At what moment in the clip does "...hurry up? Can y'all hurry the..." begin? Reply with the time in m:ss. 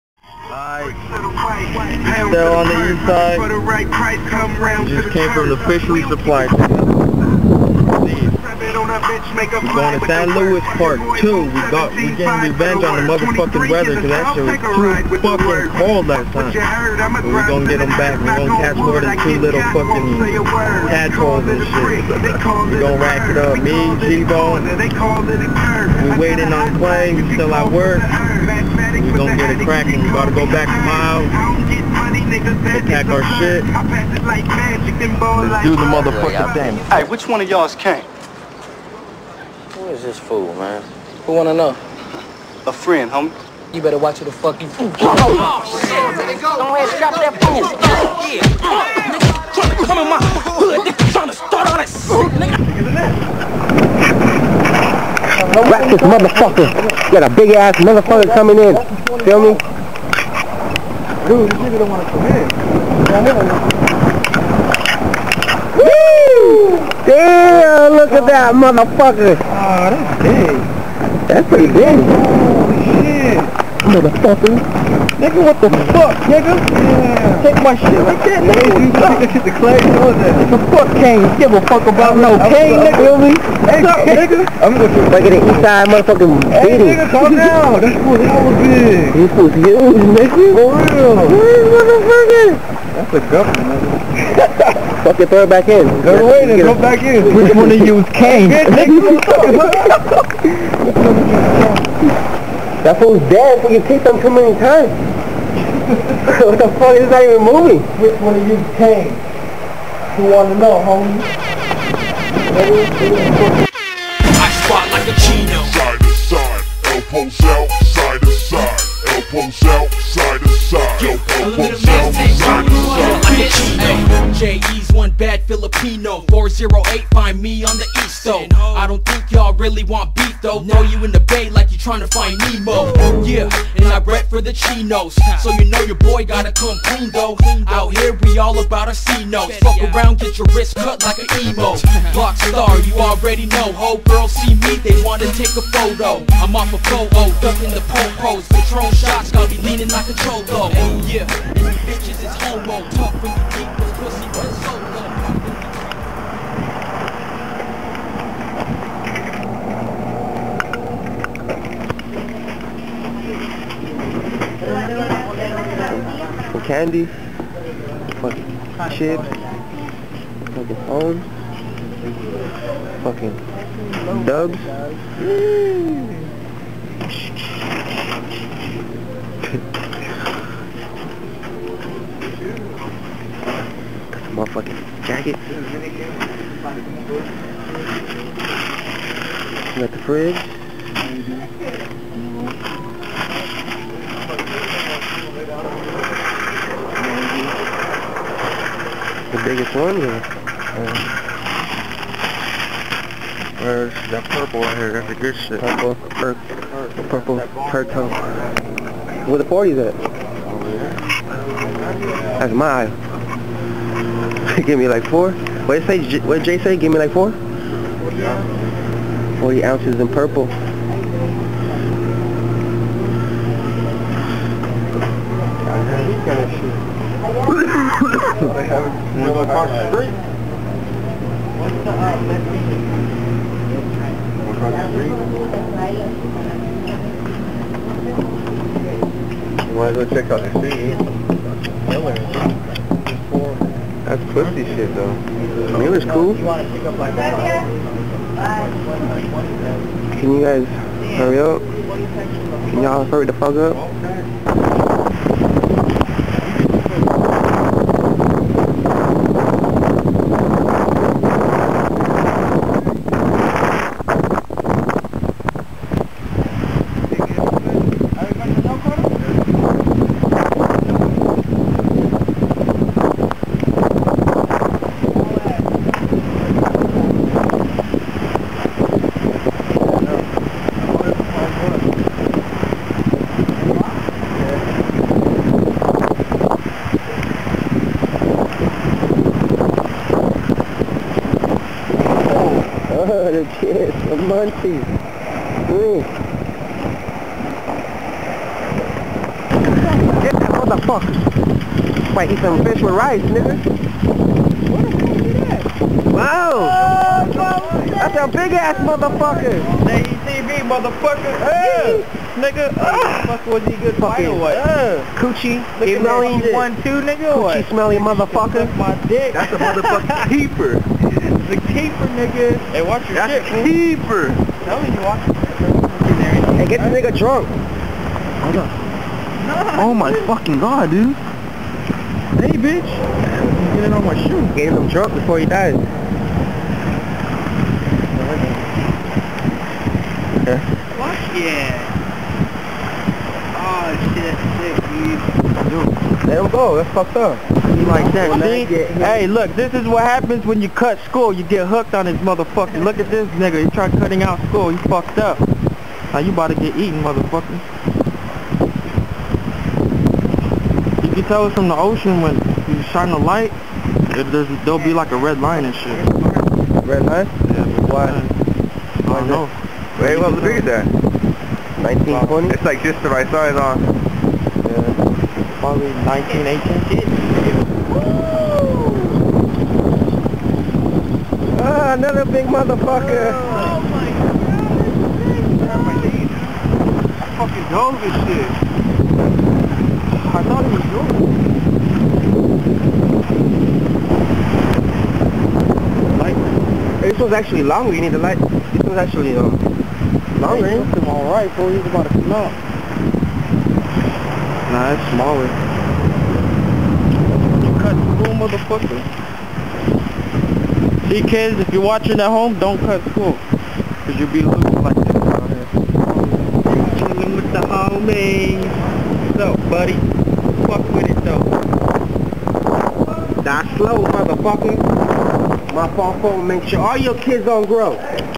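4:11.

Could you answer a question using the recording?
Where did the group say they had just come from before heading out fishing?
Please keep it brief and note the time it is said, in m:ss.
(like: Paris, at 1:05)
Fishery supply, at 0:05.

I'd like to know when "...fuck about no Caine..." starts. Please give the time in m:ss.
1:21.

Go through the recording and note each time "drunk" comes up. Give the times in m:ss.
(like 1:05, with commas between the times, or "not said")
5:27, 5:34.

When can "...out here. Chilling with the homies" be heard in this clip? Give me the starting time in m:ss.
6:55.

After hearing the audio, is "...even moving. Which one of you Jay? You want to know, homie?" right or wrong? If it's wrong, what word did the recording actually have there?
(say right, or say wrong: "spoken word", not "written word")
wrong: "Caine", not "Jay".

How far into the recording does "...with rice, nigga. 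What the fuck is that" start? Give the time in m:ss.
5:02.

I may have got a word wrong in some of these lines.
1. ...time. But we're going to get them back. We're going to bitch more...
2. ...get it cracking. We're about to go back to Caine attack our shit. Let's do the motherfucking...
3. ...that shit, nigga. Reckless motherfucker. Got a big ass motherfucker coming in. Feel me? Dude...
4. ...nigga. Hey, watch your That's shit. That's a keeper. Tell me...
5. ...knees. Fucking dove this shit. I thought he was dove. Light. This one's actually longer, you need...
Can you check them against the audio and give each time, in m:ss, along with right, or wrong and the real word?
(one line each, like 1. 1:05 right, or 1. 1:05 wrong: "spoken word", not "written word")
1. 0:16 wrong: "catch", not "bitch"
2. 0:29 wrong: "Miles", not "Caine"
3. 0:51 right
4. 5:22 right
5. 6:26 right.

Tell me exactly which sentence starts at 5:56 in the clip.
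Now you about to get eaten, motherfucker.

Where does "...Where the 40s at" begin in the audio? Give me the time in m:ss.
3:28.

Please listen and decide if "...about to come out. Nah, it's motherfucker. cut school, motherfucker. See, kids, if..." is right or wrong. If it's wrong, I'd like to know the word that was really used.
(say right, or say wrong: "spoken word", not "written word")
wrong: "smaller", not "motherfucker".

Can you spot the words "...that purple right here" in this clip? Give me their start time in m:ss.
3:24.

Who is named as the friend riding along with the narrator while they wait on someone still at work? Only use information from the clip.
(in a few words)
G-Bone.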